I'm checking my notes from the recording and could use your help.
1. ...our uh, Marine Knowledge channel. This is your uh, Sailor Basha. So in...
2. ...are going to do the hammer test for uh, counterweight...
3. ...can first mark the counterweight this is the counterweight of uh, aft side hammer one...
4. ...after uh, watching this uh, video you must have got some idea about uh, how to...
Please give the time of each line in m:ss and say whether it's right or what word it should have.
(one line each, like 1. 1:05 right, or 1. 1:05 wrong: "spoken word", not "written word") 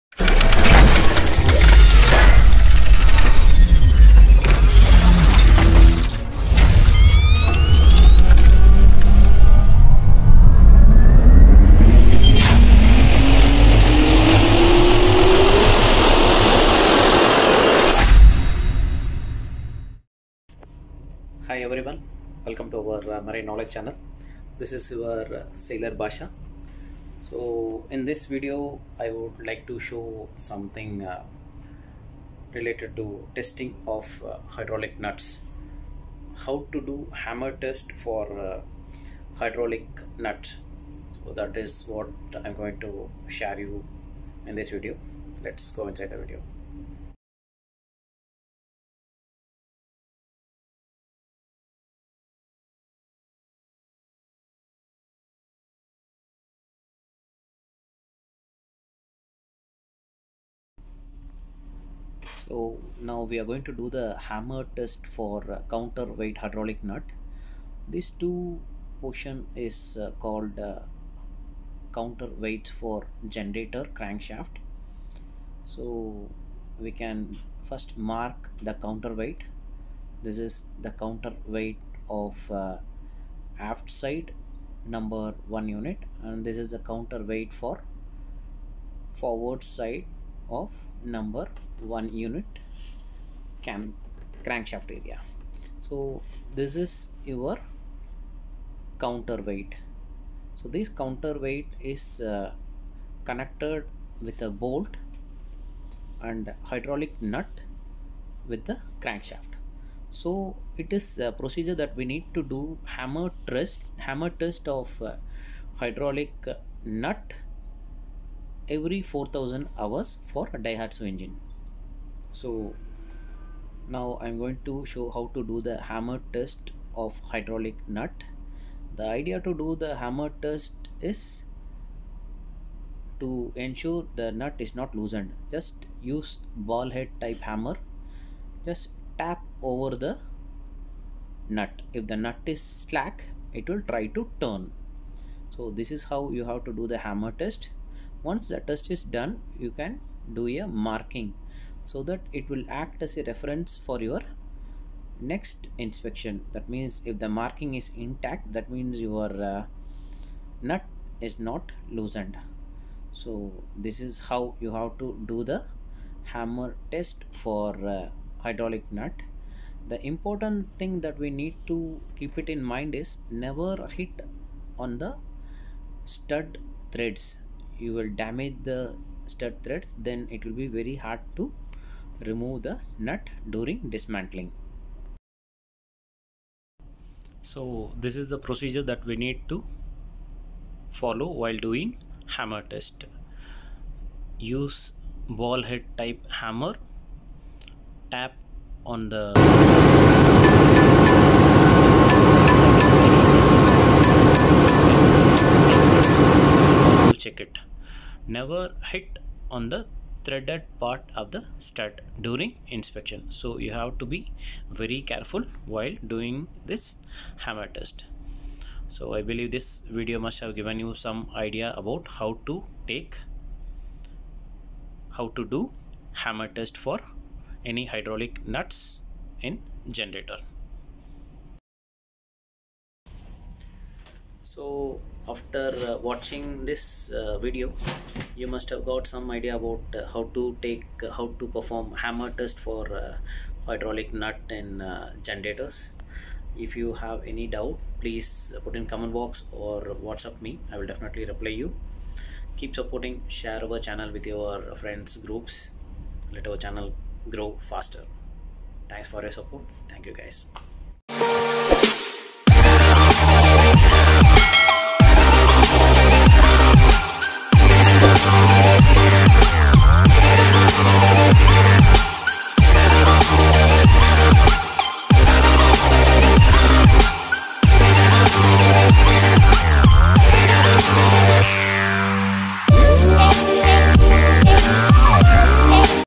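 1. 0:22 right
2. 1:03 right
3. 1:17 wrong: "number", not "hammer"
4. 3:55 right.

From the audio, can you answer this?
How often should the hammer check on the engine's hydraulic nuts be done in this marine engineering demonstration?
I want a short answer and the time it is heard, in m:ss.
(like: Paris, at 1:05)
every 4000 hours, at 1:58.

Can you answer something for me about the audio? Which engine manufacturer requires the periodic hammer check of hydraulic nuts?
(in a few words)
Daihatsu.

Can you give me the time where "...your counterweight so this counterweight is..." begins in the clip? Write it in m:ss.
1:37.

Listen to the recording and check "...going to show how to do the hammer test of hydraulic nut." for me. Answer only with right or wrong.
right.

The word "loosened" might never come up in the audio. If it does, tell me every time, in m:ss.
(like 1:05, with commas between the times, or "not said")
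2:14, 2:41.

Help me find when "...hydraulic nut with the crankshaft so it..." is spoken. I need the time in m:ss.
1:46.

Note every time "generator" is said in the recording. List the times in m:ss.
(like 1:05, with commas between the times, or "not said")
1:13, 3:50, 4:05.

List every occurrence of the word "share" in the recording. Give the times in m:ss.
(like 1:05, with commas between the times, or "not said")
0:43, 4:13.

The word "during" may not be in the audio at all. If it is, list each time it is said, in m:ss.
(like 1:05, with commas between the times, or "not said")
3:03, 3:32.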